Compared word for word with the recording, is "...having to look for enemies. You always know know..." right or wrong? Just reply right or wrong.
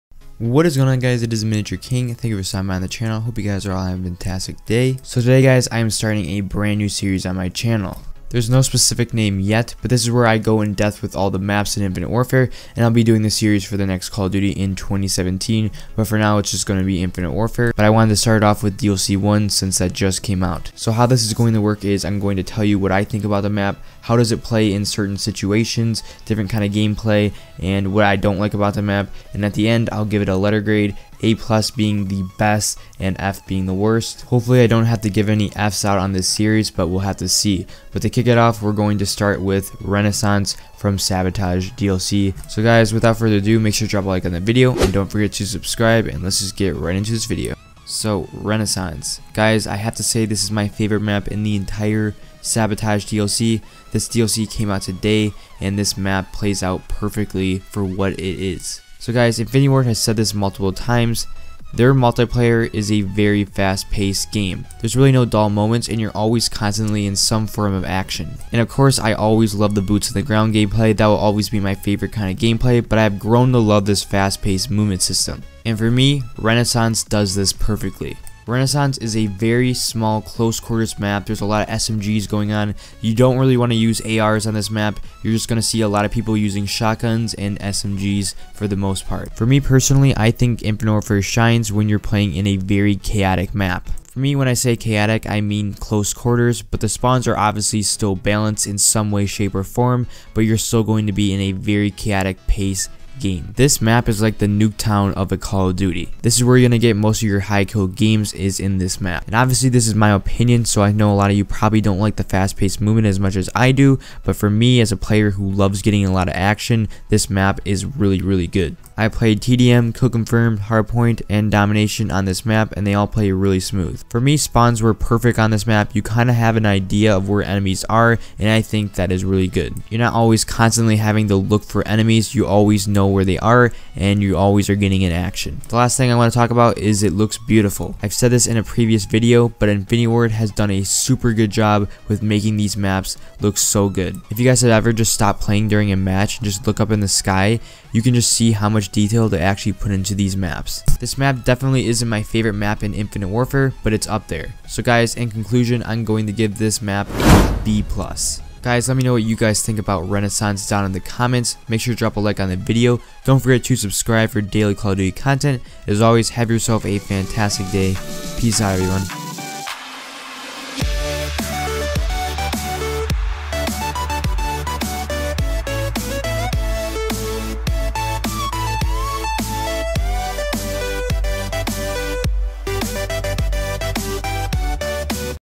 right.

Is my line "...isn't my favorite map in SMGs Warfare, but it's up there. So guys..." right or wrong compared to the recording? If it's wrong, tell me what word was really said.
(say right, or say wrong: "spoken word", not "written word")
wrong: "Infinite", not "SMGs".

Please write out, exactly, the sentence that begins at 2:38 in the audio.
Guys, let me know what you guys think about Renaissance down in the comments.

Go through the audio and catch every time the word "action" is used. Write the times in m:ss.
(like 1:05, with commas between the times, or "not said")
1:07, 1:56, 2:15.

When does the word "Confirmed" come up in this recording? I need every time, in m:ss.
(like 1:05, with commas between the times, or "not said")
2:00.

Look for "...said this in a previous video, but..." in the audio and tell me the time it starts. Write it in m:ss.
2:18.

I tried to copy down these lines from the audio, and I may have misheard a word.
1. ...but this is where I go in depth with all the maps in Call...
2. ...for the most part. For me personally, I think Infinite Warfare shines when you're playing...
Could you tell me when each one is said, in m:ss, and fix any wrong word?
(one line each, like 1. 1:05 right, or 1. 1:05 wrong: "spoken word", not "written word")
1. 0:09 wrong: "Infinite", not "Call"
2. 1:28 right.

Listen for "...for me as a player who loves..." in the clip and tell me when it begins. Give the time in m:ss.
1:54.